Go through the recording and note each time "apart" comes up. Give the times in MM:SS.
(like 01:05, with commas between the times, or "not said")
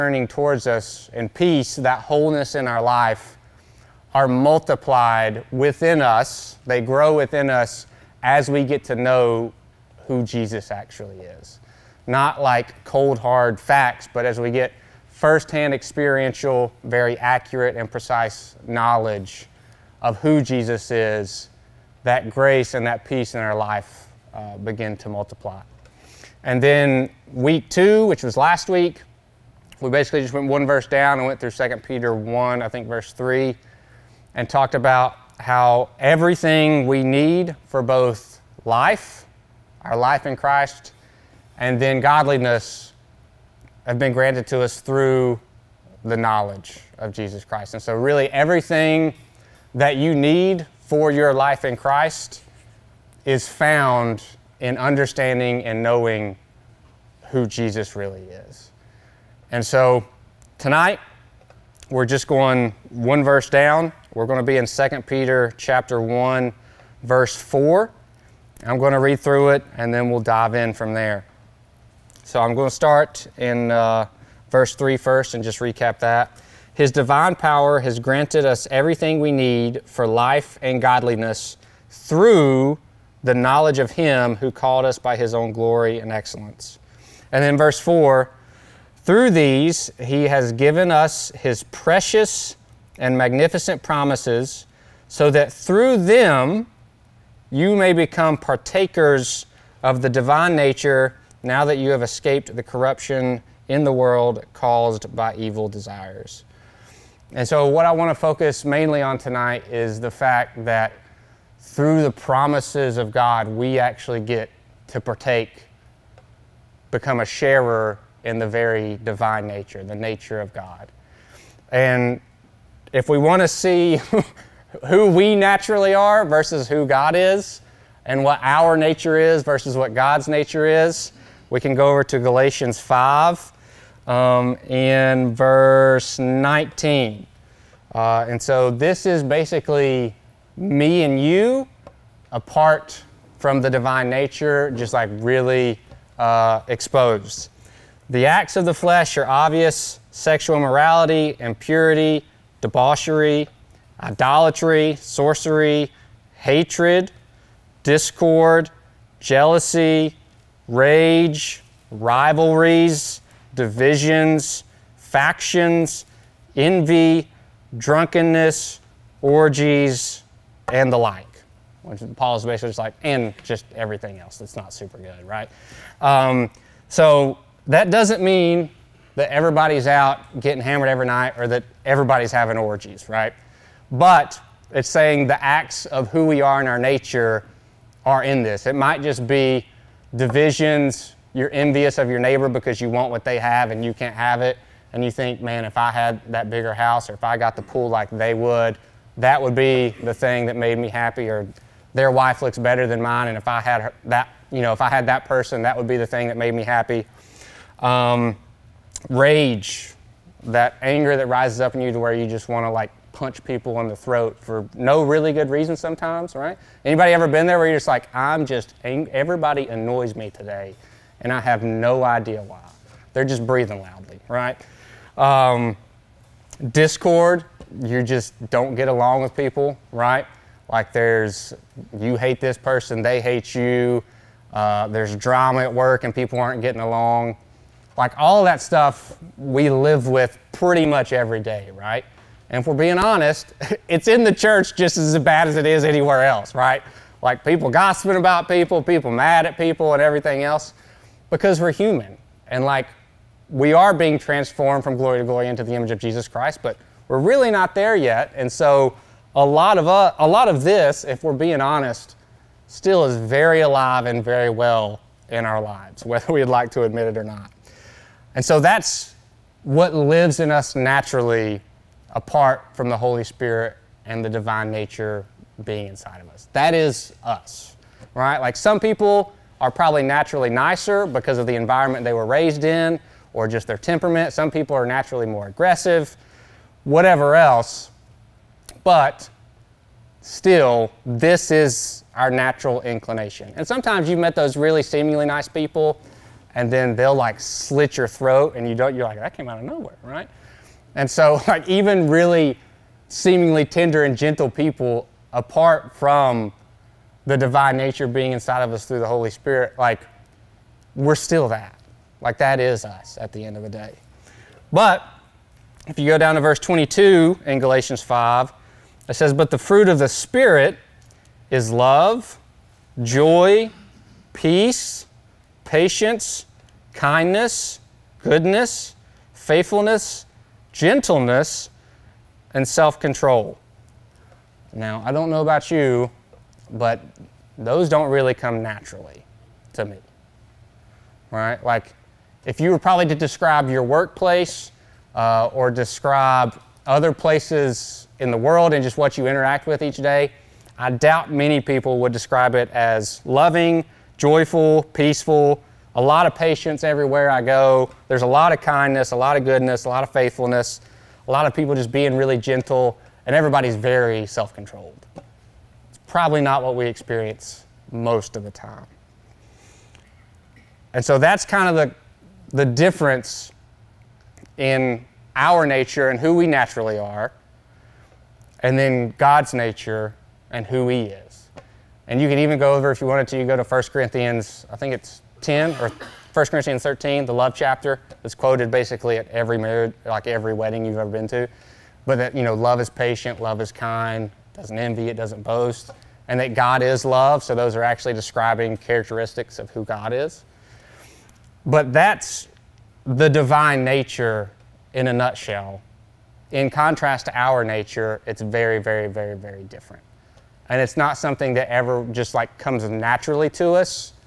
02:22, 04:32, 05:05.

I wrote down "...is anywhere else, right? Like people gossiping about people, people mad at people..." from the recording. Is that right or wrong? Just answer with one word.
right.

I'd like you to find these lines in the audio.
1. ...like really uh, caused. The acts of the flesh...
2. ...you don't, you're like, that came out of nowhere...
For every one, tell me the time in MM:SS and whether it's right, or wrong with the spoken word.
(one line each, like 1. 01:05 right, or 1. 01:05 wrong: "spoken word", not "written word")
1. 02:24 wrong: "exposed", not "caused"
2. 04:58 right.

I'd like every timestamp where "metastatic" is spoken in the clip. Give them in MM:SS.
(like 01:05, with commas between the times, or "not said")
not said.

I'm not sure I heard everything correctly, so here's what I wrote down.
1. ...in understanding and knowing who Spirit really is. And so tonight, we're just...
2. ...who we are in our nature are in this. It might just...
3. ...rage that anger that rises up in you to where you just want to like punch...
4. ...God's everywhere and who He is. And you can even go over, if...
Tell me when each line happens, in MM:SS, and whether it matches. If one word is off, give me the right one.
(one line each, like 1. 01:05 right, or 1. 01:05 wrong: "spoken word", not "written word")
1. 00:54 wrong: "Jesus", not "Spirit"
2. 03:06 right
3. 03:29 right
4. 06:19 wrong: "nature", not "everywhere".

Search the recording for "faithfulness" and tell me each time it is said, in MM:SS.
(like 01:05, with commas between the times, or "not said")
05:29, 06:00.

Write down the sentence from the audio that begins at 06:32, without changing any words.
But that, you know, love is patient, love is kind, doesn't envy, it doesn't boast, and that God is love.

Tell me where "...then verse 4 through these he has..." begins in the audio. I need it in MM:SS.
01:27.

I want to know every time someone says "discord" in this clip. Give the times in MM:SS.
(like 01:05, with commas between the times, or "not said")
02:37, 03:46.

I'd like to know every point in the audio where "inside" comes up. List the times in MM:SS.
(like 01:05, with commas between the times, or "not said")
04:35, 05:08.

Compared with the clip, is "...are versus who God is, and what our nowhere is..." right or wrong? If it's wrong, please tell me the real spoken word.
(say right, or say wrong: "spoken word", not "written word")
wrong: "nature", not "nowhere".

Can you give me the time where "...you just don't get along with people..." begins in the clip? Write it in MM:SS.
03:47.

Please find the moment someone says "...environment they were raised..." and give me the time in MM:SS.
04:41.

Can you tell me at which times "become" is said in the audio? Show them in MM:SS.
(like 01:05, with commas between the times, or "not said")
01:37, 01:56.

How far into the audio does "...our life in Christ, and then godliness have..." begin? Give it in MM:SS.
00:39.